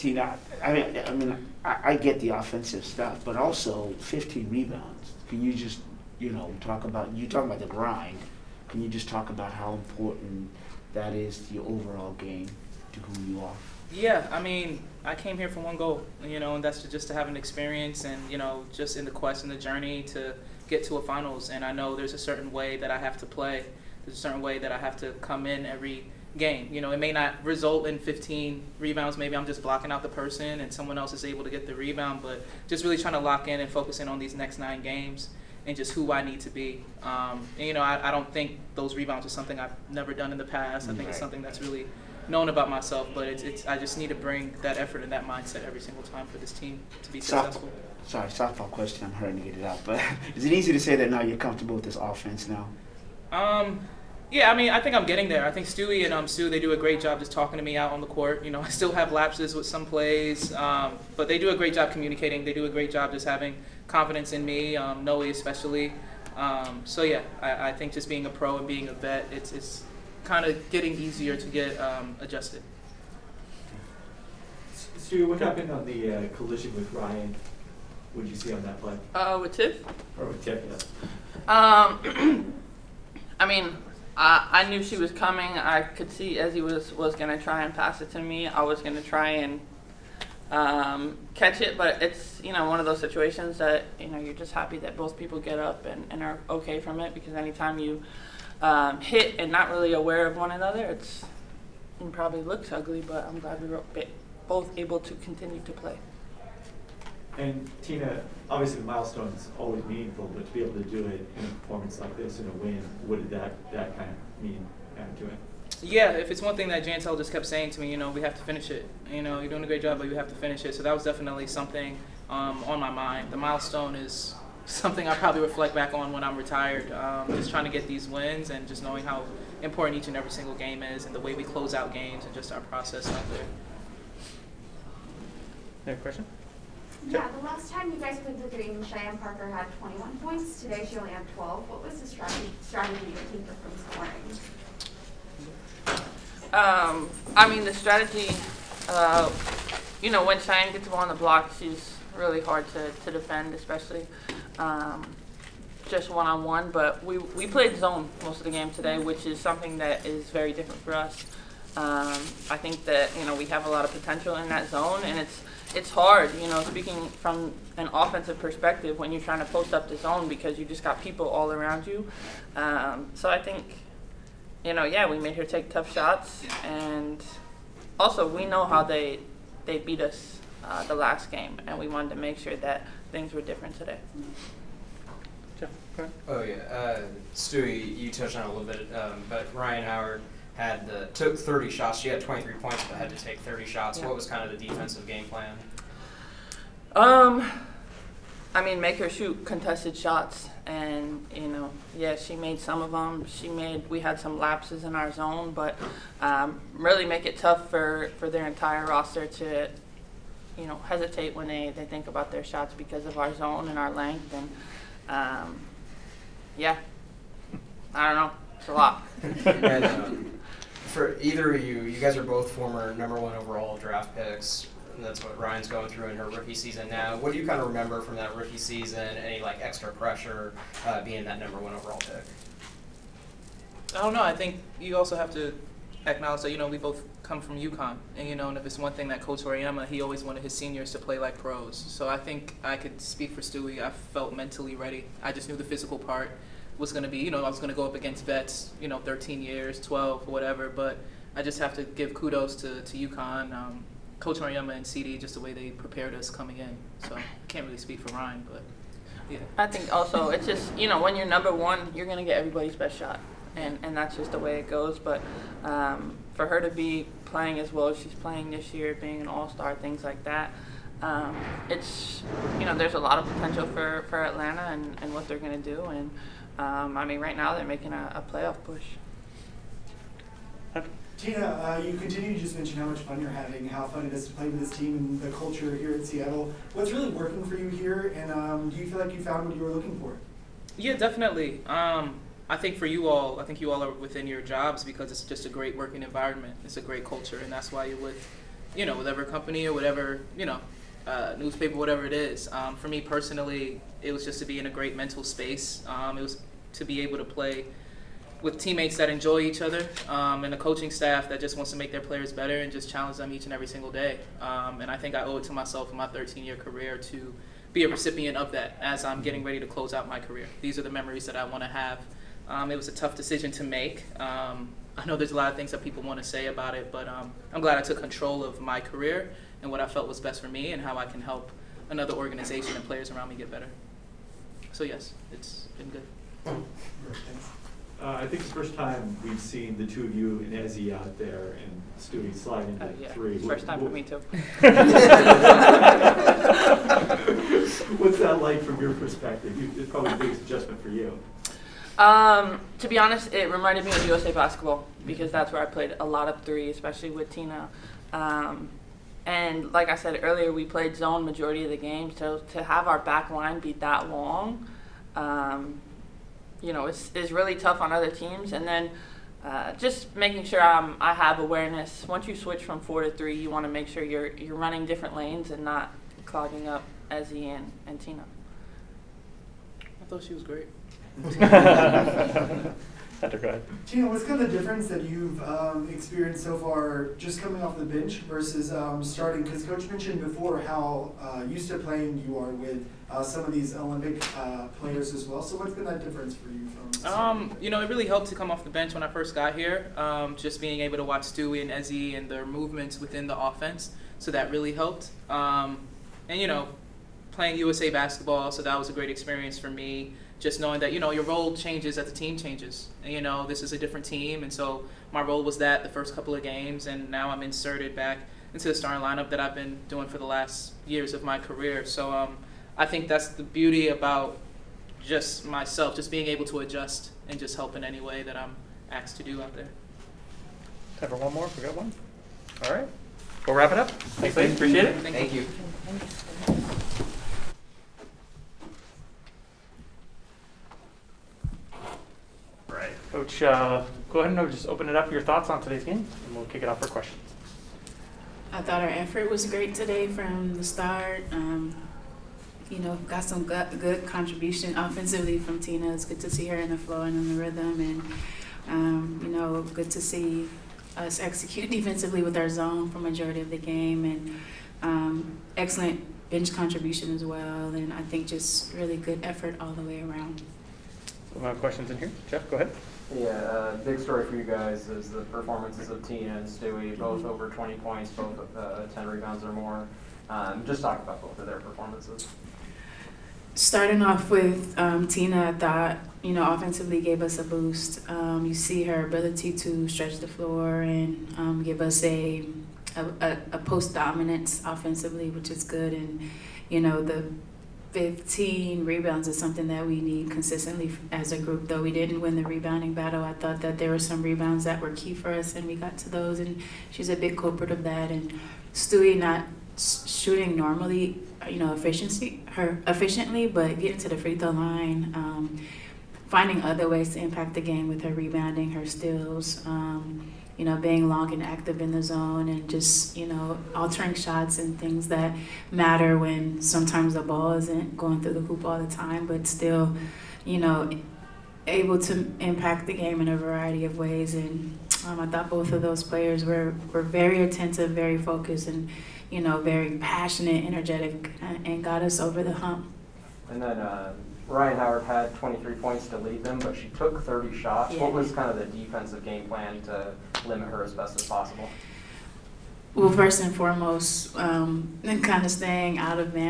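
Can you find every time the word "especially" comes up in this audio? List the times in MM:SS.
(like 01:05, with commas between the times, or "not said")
01:05, 02:33, 05:56.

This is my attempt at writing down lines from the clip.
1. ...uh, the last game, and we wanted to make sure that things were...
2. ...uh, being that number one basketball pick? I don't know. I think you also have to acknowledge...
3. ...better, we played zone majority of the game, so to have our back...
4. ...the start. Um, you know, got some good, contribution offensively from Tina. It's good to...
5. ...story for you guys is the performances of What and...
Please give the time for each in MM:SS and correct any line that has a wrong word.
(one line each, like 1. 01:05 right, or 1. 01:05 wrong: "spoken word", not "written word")
1. 03:00 right
2. 03:50 wrong: "overall", not "basketball"
3. 06:00 wrong: "earlier", not "better"
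4. 07:30 right
5. 07:53 wrong: "Tina", not "What".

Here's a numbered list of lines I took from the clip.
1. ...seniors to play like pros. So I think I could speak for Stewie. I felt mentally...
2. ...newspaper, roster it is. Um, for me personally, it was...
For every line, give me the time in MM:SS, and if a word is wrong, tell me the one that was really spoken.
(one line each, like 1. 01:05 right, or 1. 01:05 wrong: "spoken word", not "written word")
1. 04:00 right
2. 05:01 wrong: "whatever", not "roster".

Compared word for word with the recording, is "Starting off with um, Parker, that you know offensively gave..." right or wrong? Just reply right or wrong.
wrong.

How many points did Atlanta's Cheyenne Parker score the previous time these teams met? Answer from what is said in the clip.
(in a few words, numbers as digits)
21.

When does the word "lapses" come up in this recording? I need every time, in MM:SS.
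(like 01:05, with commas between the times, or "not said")
00:59, 03:24.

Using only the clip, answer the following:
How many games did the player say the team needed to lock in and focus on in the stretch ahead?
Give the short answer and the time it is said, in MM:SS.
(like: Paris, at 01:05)
9, at 00:34.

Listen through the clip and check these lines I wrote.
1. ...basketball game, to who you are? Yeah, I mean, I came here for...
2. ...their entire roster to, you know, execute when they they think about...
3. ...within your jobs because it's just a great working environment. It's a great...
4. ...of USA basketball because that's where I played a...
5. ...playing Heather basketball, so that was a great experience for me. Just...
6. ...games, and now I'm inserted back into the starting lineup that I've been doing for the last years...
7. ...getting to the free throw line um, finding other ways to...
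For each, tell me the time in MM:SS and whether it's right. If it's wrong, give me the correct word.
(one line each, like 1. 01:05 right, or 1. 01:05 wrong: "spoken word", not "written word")
1. 00:11 wrong: "overall", not "basketball"
2. 03:28 wrong: "hesitate", not "execute"
3. 04:53 right
4. 05:53 right
5. 06:47 wrong: "USA", not "Heather"
6. 06:56 right
7. 08:33 right.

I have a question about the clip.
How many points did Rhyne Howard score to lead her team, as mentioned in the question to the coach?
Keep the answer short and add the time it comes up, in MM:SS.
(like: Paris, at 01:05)
23, at 09:05.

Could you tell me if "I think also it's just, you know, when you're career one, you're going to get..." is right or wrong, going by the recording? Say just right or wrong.
wrong.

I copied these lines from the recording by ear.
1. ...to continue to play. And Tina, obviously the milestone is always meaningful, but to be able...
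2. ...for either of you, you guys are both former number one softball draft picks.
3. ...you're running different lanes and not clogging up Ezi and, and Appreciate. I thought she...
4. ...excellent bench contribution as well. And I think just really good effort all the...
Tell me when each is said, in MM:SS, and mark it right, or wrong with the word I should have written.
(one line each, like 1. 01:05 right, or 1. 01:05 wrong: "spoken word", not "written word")
1. 01:44 right
2. 03:40 wrong: "overall", not "softball"
3. 06:14 wrong: "Tina", not "Appreciate"
4. 07:45 right.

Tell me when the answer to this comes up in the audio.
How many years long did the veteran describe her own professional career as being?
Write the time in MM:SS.
05:16.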